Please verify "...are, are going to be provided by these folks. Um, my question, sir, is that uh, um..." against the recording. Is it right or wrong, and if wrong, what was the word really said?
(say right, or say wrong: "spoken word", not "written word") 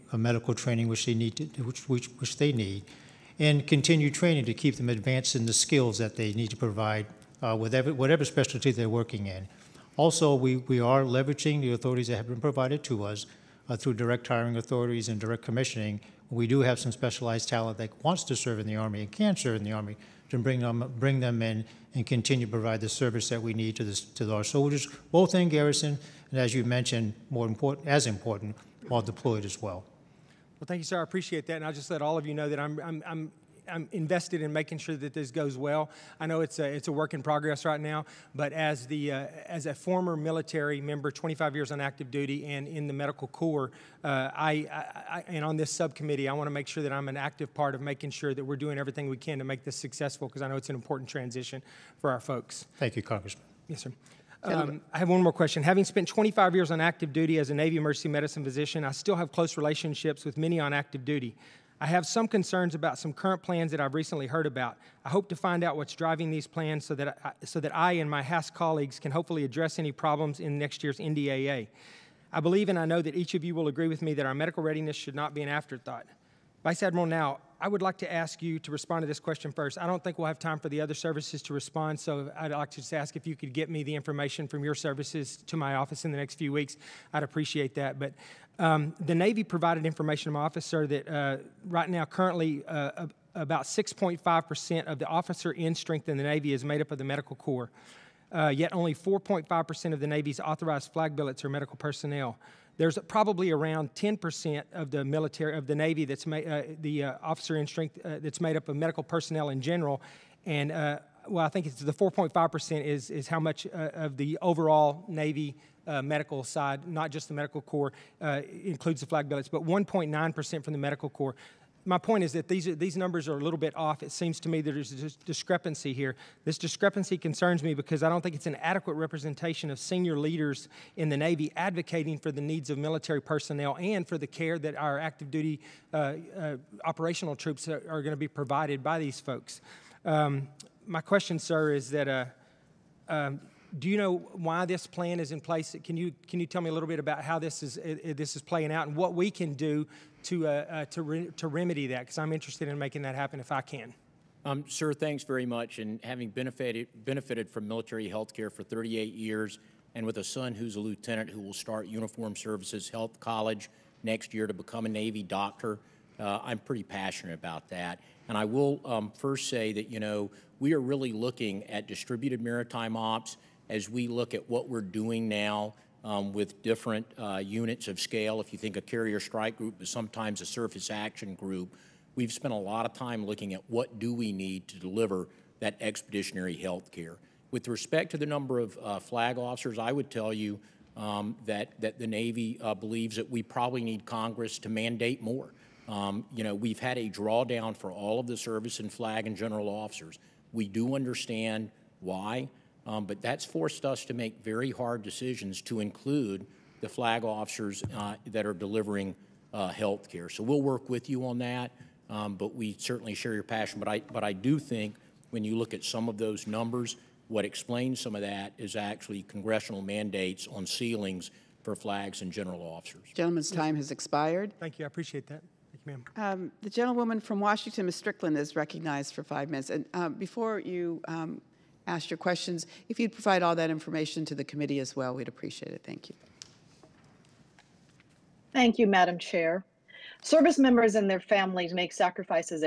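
right.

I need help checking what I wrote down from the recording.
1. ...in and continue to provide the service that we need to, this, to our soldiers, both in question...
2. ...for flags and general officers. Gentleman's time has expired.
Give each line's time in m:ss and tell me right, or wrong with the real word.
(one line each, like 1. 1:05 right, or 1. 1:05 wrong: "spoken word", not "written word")
1. 0:21 wrong: "garrison", not "question"
2. 3:41 right.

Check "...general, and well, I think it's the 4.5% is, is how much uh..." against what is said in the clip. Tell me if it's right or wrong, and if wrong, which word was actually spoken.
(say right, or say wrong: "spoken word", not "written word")
right.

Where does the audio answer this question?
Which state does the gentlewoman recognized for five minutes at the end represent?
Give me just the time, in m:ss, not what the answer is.
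3:47.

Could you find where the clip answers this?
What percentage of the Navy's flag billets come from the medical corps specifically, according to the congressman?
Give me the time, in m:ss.
1:59.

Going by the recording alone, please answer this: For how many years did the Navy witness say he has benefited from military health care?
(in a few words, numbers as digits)
38 years.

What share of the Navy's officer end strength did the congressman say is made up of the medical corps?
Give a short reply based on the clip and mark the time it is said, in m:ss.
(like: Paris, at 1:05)
6.5%, at 1:33.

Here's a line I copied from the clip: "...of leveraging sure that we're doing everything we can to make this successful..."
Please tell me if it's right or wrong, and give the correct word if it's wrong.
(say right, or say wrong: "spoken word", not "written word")
wrong: "making", not "leveraging".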